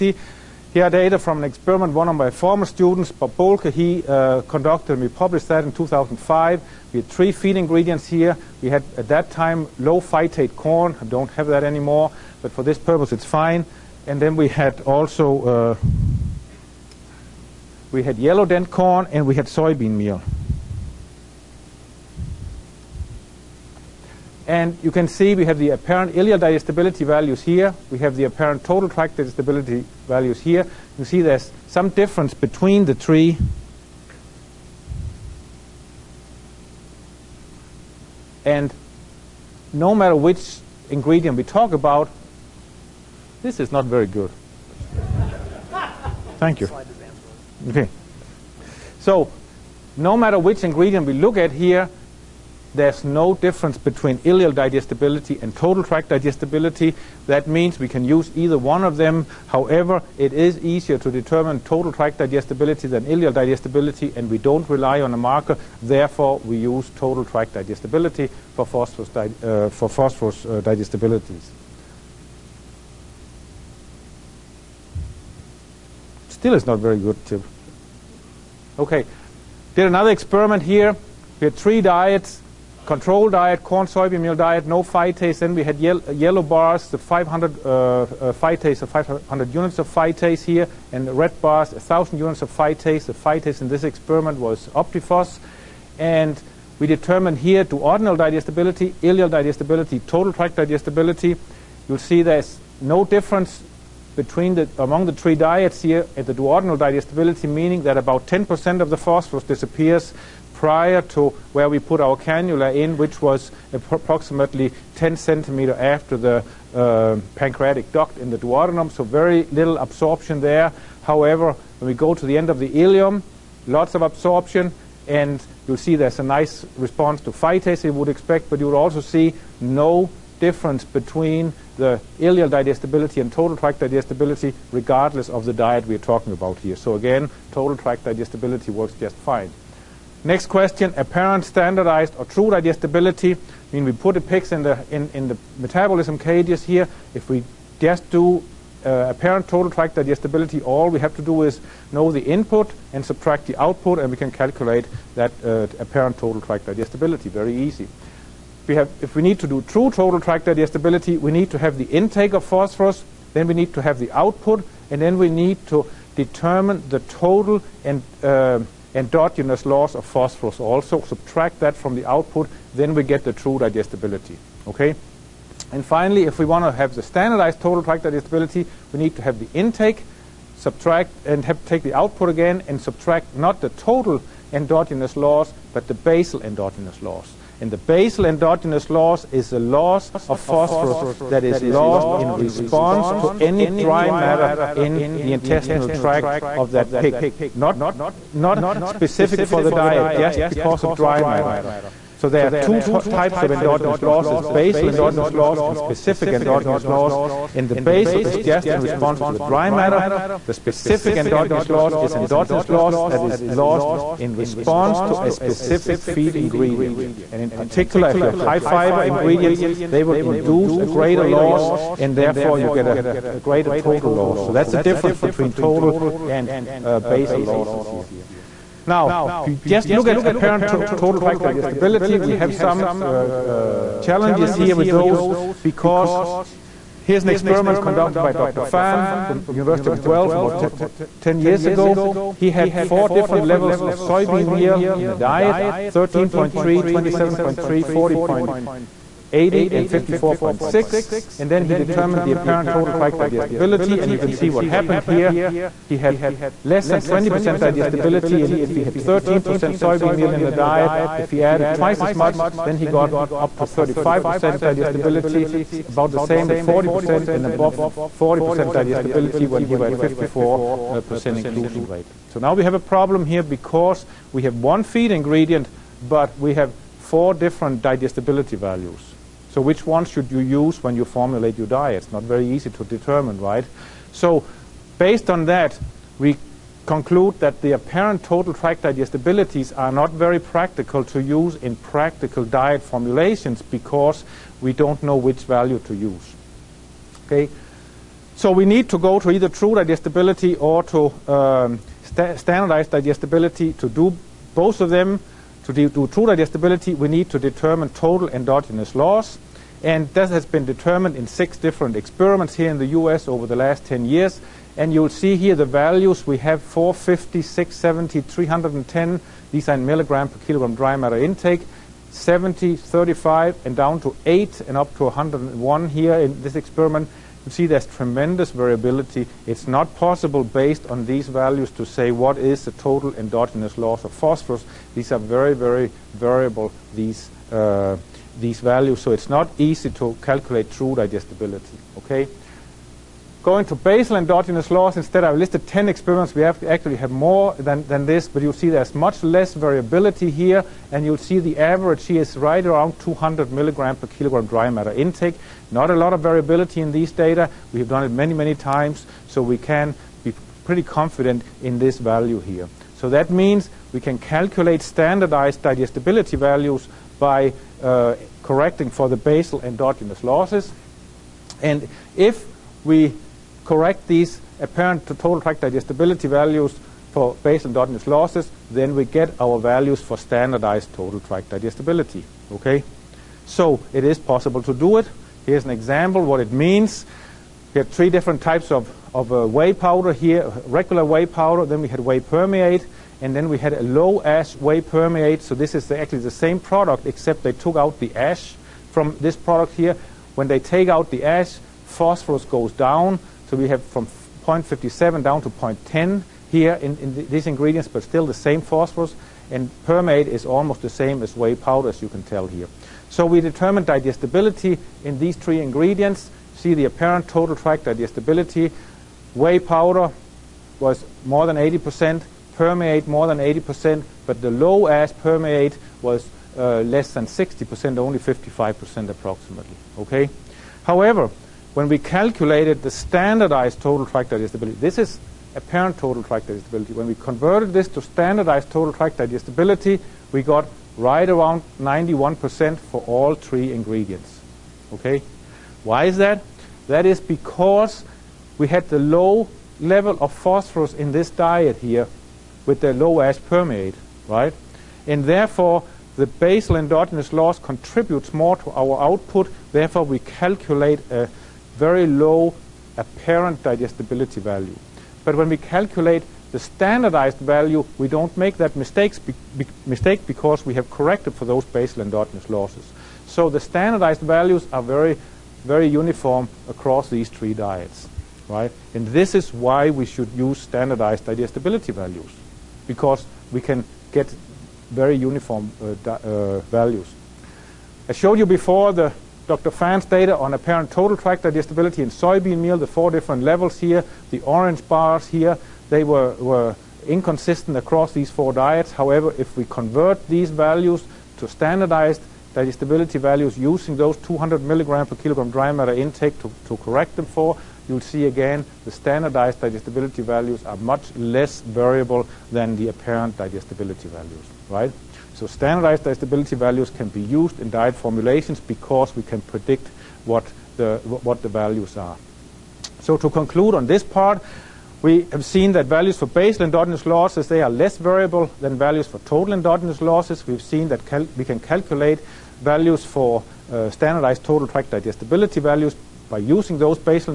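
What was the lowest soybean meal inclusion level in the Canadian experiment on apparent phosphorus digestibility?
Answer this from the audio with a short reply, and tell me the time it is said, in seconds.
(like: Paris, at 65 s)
13.3, at 245 s.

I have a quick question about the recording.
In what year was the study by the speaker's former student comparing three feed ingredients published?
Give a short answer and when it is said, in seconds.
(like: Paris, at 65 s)
2005, at 5 s.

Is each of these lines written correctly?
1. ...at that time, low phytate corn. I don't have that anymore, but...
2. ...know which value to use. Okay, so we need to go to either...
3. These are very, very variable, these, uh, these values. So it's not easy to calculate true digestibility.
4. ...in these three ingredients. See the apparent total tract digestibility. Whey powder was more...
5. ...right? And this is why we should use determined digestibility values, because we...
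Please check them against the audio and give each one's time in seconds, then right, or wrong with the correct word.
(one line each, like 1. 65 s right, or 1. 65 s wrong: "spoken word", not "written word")
1. 8 s right
2. 295 s right
3. 334 s right
4. 415 s right
5. 478 s wrong: "standardized", not "determined".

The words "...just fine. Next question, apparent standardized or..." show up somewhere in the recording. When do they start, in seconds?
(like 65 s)
138 s.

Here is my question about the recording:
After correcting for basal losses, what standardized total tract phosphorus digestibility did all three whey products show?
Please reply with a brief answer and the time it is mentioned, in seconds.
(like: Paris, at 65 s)
91%, at 441 s.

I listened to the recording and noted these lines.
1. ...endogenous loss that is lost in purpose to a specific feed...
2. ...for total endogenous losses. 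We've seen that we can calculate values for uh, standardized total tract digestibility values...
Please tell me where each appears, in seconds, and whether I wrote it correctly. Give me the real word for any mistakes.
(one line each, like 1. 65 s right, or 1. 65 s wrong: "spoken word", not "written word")
1. 212 s wrong: "response", not "purpose"
2. 529 s right.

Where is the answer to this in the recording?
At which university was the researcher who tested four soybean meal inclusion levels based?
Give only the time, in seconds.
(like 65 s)
239 s.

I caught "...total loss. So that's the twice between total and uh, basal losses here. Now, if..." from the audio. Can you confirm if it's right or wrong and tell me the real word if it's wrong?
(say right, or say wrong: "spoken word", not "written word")
wrong: "difference", not "twice".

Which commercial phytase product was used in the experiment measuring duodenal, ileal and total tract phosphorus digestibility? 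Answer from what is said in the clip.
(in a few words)
OptiPhos.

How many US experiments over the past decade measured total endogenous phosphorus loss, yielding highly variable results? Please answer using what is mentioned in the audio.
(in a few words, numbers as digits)
6.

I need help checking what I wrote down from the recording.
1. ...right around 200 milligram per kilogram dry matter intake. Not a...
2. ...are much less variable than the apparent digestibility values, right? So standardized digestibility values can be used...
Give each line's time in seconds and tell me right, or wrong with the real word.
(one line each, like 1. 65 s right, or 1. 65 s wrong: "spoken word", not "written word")
1. 352 s right
2. 510 s right.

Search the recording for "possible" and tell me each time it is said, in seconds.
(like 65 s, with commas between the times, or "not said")
329 s, 384 s.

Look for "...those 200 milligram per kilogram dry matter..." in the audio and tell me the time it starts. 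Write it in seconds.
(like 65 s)
503 s.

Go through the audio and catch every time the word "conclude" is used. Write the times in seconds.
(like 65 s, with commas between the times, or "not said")
286 s, 523 s.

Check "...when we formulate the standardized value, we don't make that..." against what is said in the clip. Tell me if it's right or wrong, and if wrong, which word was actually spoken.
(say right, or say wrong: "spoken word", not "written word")
wrong: "calculate", not "formulate".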